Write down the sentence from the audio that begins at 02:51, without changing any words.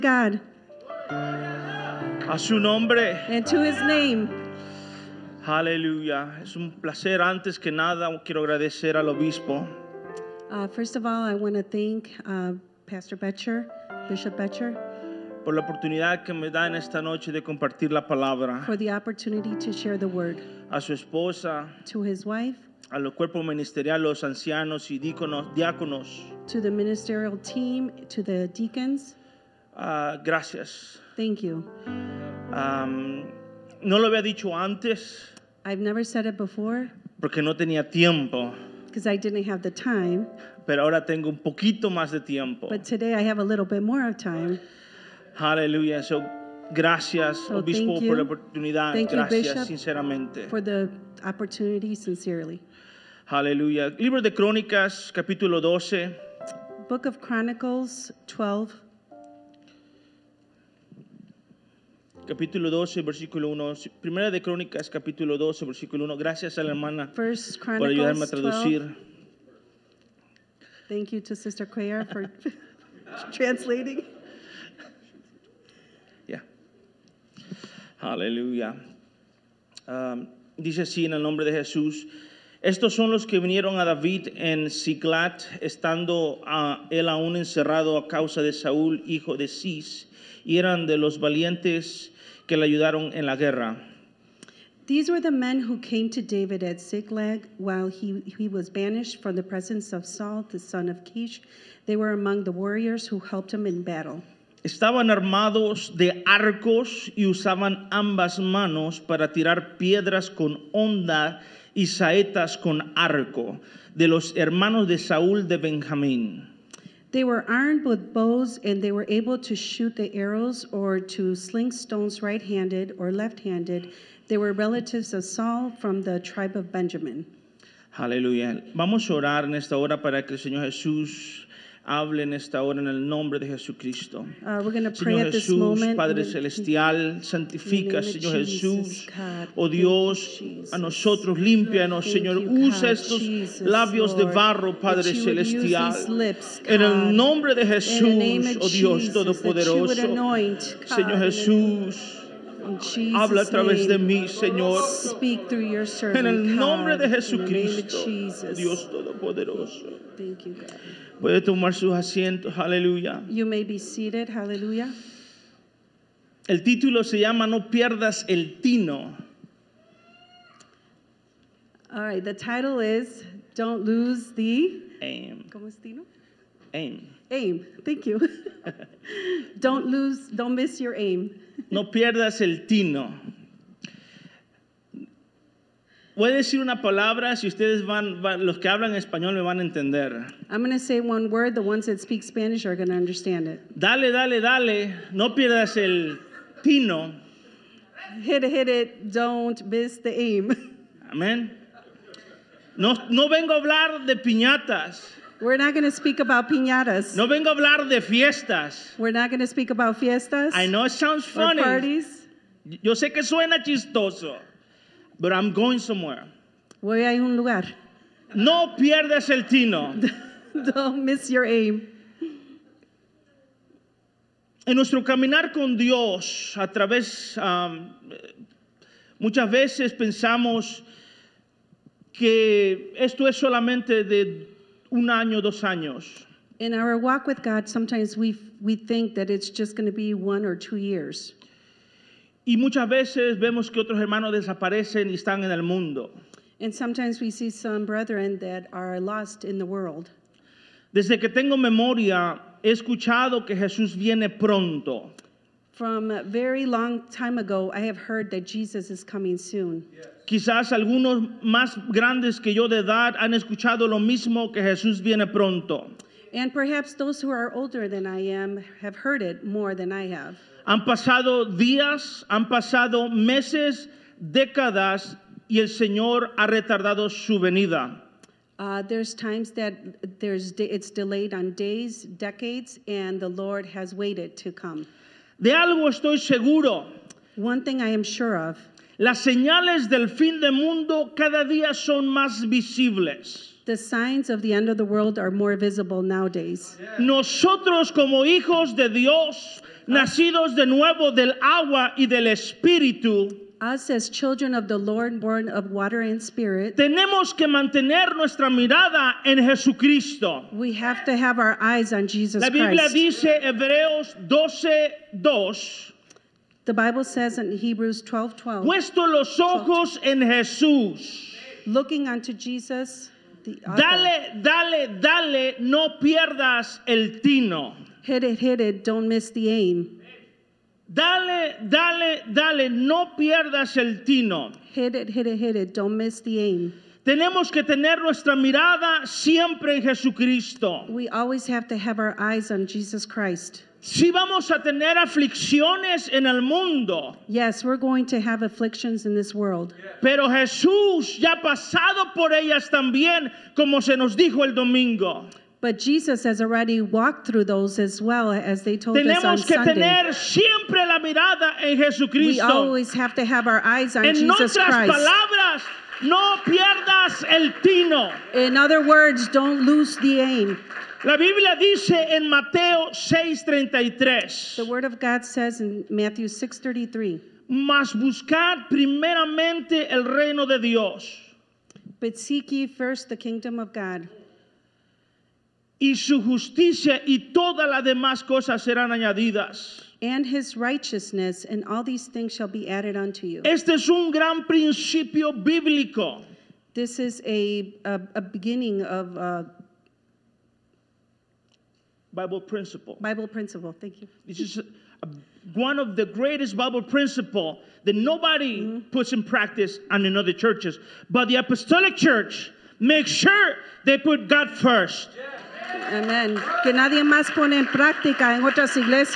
All right, the title is Don't lose the aim.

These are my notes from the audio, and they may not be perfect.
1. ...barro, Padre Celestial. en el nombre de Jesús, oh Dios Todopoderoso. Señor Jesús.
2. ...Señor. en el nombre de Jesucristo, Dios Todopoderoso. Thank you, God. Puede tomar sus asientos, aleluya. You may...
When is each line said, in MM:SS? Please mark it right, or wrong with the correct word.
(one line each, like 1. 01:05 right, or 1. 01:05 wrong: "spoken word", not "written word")
1. 02:24 right
2. 02:34 right.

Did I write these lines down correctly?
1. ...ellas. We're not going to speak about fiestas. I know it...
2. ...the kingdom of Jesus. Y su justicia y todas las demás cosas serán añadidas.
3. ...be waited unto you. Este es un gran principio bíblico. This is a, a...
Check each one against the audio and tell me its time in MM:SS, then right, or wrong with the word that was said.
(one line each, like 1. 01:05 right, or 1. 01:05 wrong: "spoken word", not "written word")
1. 03:28 wrong: "fiestas", not "ellas"
2. 06:23 wrong: "God", not "Jesus"
3. 06:32 wrong: "added", not "waited".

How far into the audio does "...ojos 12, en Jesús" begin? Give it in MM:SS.
05:19.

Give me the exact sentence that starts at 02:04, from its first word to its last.
They were relatives of Saul from the tribe of Benjamin.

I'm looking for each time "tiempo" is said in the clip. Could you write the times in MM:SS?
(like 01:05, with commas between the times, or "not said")
00:37, 00:42.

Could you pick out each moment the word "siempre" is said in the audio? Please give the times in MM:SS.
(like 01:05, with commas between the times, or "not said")
05:39, 06:00.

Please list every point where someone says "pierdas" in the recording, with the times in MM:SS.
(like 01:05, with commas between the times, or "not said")
02:47, 03:01, 03:15, 03:38, 05:26, 05:33, 06:06.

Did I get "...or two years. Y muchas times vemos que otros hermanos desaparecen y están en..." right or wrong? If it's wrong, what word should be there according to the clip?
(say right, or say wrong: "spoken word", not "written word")
wrong: "veces", not "times".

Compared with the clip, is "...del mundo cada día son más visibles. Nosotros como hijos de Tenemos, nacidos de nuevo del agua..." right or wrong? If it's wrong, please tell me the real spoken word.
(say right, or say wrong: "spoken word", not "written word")
wrong: "Dios", not "Tenemos".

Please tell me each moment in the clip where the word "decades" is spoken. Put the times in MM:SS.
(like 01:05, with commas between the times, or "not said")
04:42.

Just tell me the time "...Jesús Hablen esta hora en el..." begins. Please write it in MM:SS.
02:10.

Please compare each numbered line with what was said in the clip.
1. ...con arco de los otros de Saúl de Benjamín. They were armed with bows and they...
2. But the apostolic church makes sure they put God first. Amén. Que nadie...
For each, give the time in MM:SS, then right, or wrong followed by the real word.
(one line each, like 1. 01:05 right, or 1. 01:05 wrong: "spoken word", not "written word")
1. 01:52 wrong: "hermanos", not "otros"
2. 06:51 right.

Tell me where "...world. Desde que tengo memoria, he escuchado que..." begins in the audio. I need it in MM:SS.
04:09.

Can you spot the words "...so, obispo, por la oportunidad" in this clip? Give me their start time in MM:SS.
00:47.